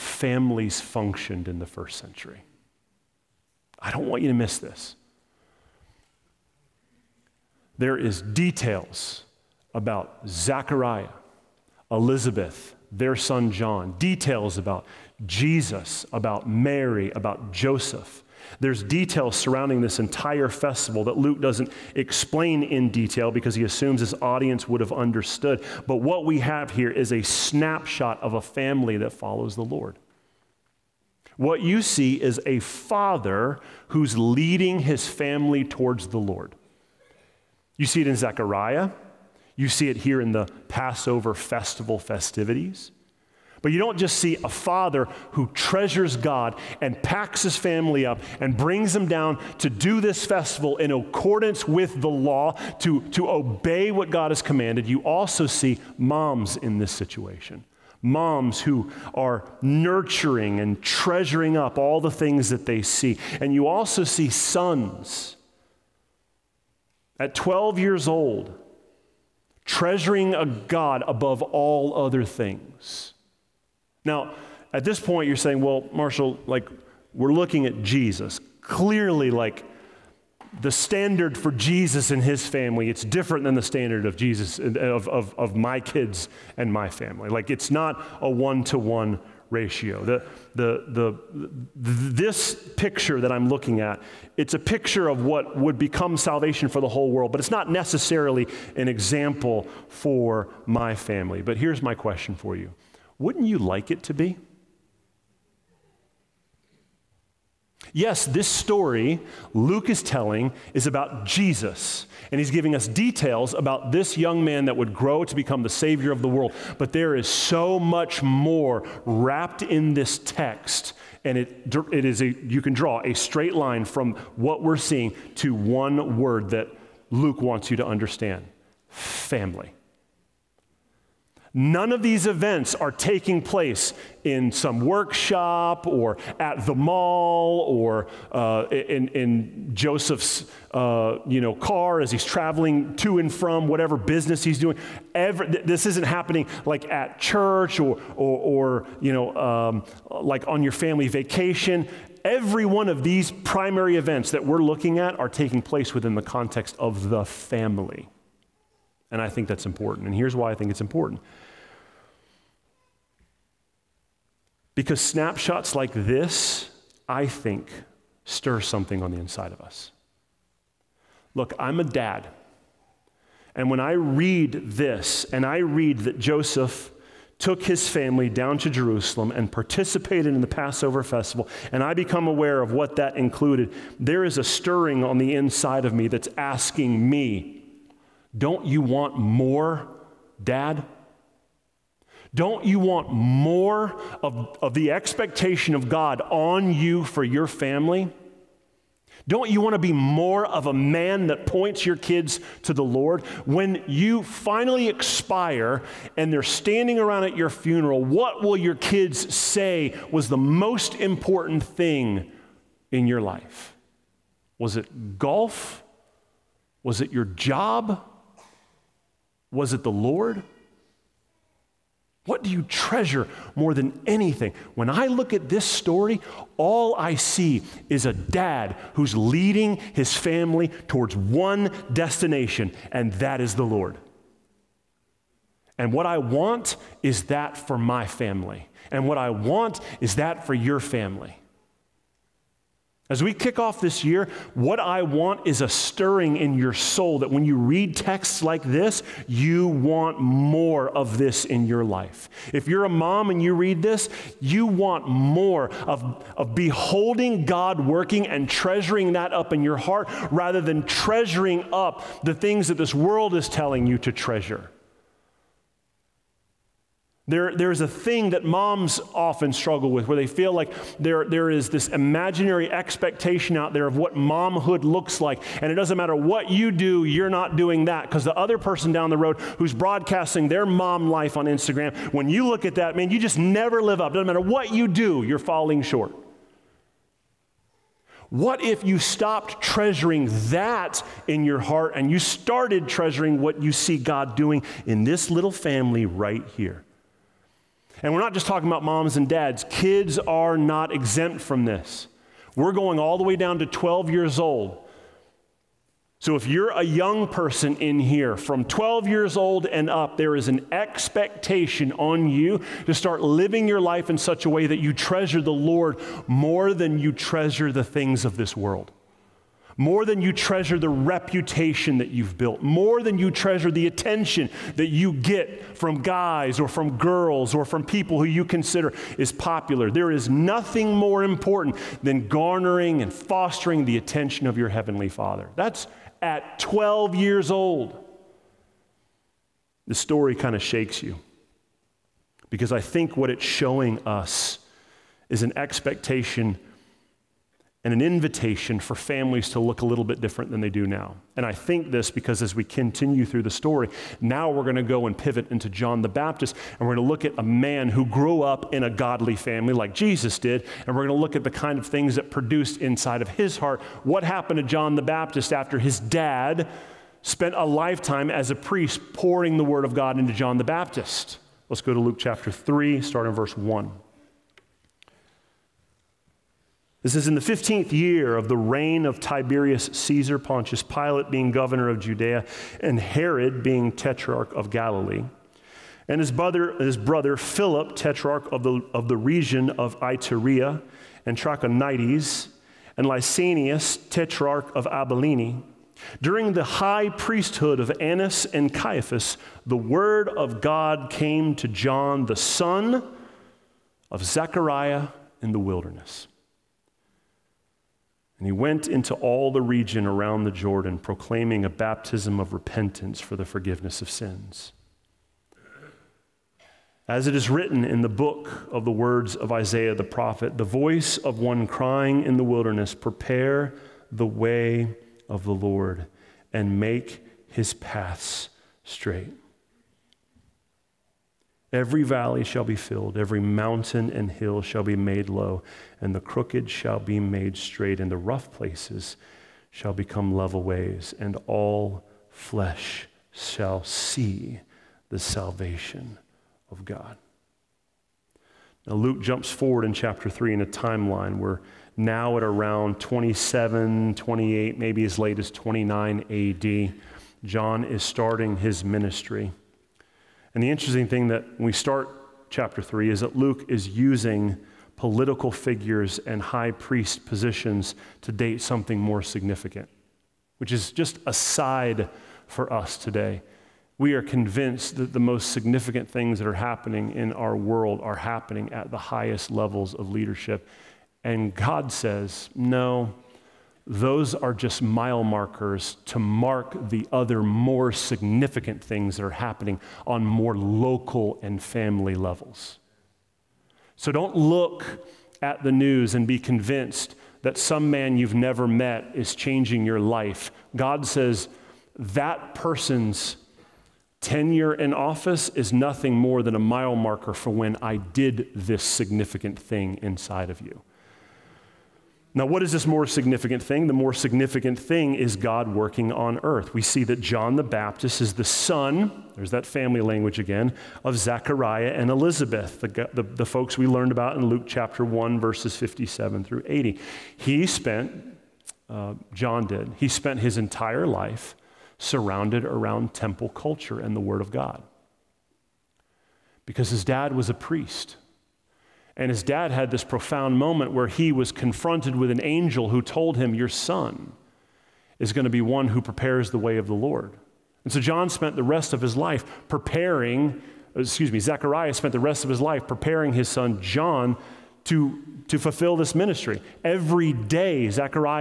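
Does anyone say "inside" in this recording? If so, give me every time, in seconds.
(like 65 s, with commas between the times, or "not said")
169 s, 185 s, 362 s, 510 s.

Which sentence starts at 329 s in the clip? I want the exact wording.
There is nothing more important than garnering and fostering the attention of your Heavenly Father.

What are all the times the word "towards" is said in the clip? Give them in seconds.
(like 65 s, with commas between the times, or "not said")
35 s, 230 s.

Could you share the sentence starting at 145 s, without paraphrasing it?
Every, this isn't happening like at church or, or, or you know, um, like on your family vacation.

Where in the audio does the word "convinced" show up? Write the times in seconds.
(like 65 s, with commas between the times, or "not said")
474 s, 496 s.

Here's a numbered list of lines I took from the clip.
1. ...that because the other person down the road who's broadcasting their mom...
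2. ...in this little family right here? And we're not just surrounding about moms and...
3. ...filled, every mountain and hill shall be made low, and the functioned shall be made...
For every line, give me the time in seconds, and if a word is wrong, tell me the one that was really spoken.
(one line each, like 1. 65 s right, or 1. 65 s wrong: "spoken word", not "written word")
1. 277 s right
2. 294 s wrong: "talking", not "surrounding"
3. 432 s wrong: "crooked", not "functioned".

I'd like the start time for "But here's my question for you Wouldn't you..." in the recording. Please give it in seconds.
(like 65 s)
101 s.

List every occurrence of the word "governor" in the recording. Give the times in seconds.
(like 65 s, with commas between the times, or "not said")
381 s.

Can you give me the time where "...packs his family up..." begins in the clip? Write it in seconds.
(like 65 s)
47 s.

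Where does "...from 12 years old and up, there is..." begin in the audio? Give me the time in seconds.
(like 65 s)
308 s.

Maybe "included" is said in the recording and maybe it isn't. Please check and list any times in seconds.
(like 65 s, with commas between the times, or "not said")
183 s.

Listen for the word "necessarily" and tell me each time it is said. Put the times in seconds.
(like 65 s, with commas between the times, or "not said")
97 s.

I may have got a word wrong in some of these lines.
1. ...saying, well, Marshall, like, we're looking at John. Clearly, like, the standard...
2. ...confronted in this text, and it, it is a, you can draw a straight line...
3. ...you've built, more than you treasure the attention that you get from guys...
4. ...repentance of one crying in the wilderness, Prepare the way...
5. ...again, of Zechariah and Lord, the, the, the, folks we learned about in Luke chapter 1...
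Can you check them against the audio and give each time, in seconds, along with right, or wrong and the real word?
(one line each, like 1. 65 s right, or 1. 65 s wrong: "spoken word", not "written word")
1. 75 s wrong: "Jesus", not "John"
2. 119 s wrong: "wrapped", not "confronted"
3. 322 s right
4. 420 s wrong: "voice", not "repentance"
5. 520 s wrong: "Elizabeth", not "Lord".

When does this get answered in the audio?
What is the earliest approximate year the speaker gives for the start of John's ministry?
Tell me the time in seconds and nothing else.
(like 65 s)
452 s.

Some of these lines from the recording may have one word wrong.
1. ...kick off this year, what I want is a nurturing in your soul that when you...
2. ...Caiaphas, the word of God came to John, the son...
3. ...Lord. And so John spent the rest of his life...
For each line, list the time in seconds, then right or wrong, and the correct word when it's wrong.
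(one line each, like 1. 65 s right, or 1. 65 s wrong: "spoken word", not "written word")
1. 243 s wrong: "stirring", not "nurturing"
2. 398 s right
3. 546 s right.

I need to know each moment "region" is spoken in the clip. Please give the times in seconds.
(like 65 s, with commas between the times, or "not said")
389 s, 409 s.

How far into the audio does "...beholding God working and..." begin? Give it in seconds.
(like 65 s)
256 s.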